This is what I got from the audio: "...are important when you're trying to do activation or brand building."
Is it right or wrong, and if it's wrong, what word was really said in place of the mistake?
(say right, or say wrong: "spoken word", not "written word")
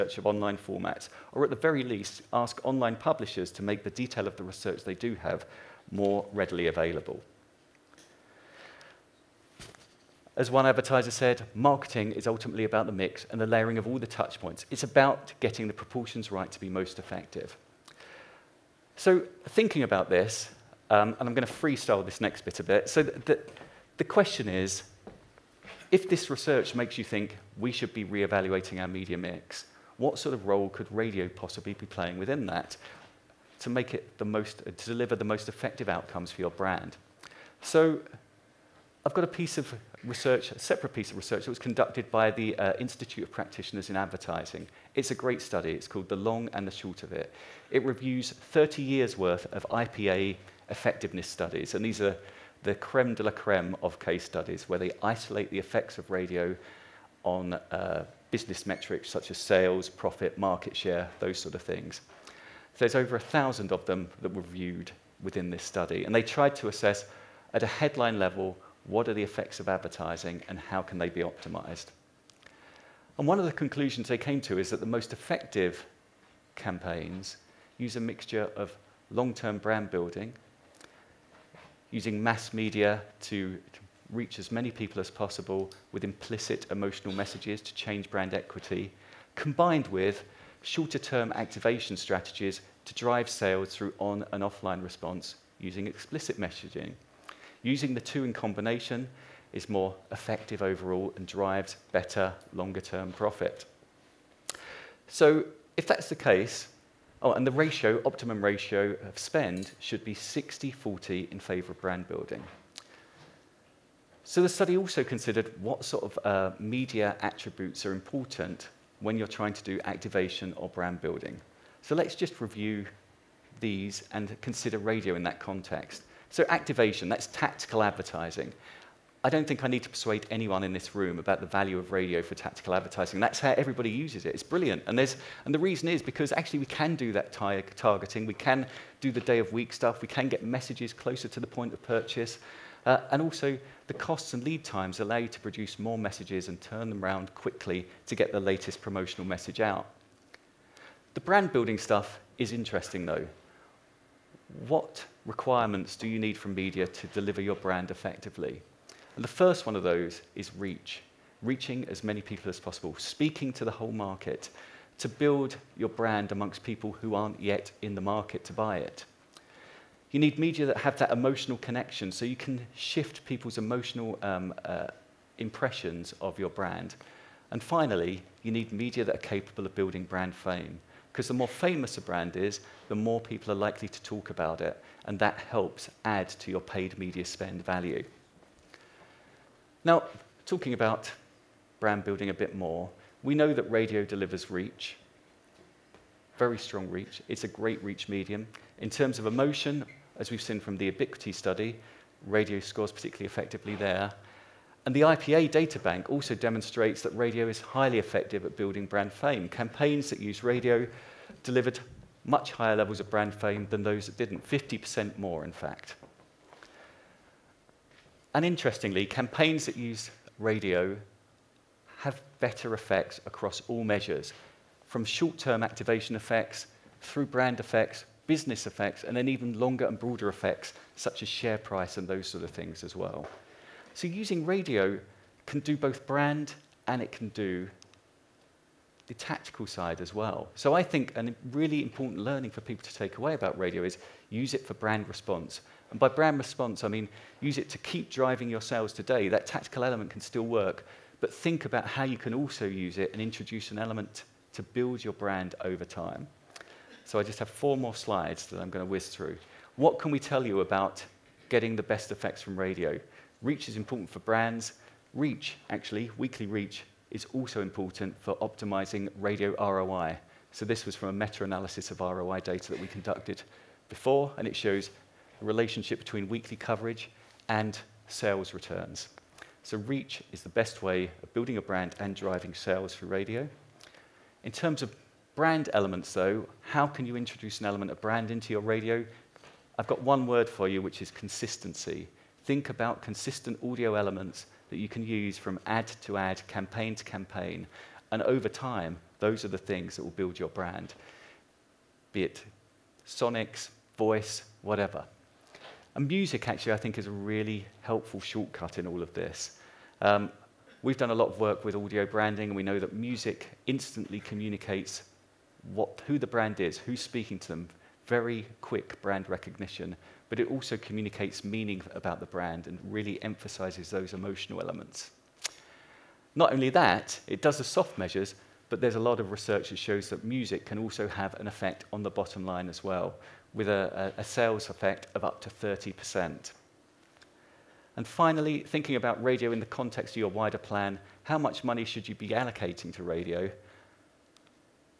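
right.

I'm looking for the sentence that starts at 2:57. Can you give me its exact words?
And finally, you need media that are capable of building brand fame.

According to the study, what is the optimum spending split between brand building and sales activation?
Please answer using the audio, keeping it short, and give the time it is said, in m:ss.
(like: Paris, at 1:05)
60-40, at 1:50.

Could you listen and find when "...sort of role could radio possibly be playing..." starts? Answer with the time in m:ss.
0:30.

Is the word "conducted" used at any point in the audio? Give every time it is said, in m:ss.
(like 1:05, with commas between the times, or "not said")
0:41, 4:32.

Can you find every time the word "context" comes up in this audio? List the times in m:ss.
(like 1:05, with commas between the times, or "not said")
2:05, 5:39.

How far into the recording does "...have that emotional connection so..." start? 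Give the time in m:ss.
2:50.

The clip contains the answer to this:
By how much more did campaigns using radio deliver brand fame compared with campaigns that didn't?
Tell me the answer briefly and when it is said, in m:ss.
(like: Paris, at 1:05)
50%, at 3:34.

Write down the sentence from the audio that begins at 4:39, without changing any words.
So reach is the best way of building a brand and driving sales through radio.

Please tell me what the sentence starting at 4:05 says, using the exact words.
And by brand response, I mean use it to keep driving your sales today.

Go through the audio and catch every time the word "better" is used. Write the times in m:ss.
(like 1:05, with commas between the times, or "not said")
1:41, 3:42.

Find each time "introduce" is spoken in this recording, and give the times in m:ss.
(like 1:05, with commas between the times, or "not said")
4:13, 4:47.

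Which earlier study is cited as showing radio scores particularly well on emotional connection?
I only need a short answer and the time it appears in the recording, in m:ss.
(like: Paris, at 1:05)
Ubiquity study, at 3:20.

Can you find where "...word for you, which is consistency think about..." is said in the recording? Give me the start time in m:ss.
4:50.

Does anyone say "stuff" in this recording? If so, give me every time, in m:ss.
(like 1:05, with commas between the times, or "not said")
2:19, 2:31.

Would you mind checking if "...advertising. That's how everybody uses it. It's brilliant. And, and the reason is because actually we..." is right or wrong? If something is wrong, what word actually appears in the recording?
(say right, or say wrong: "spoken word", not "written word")
right.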